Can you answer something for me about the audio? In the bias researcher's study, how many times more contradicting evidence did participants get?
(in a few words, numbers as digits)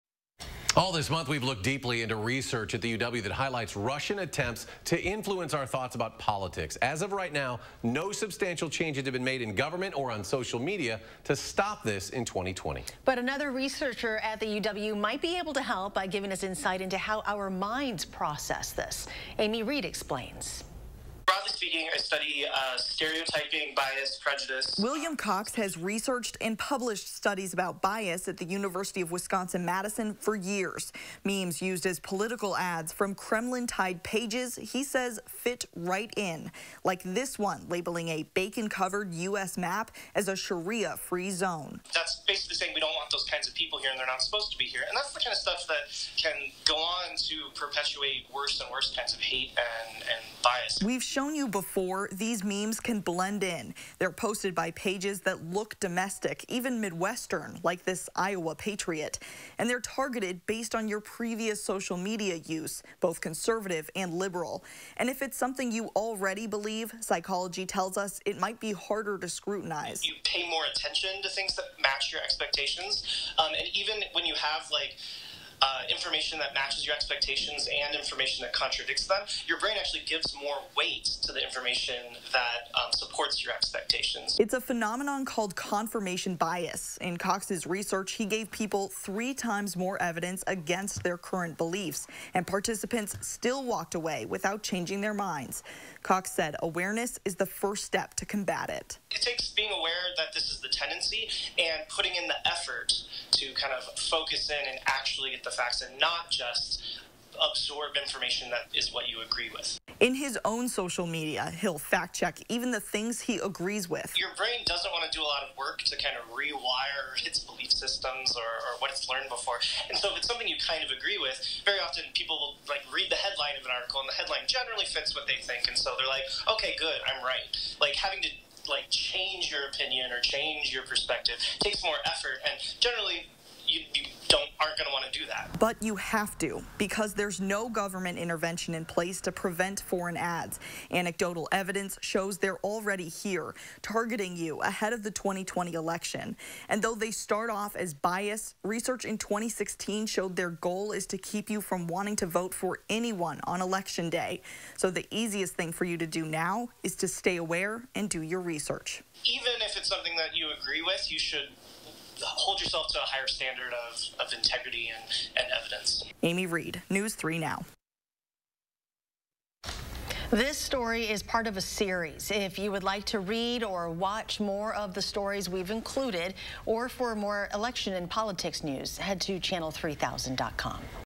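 3.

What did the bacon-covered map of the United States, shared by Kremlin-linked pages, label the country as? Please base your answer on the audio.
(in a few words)
Sharia free zone.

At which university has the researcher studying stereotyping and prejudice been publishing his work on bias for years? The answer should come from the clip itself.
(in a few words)
University of Wisconsin Madison.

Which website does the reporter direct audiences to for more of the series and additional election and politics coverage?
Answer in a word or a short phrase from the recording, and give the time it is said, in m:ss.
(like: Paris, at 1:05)
channel3000.com, at 2:59.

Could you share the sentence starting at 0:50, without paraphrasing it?
We've shown shown you before, these memes can blend in.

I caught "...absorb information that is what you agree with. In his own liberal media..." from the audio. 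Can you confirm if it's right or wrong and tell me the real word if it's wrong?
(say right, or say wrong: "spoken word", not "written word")
wrong: "social", not "liberal".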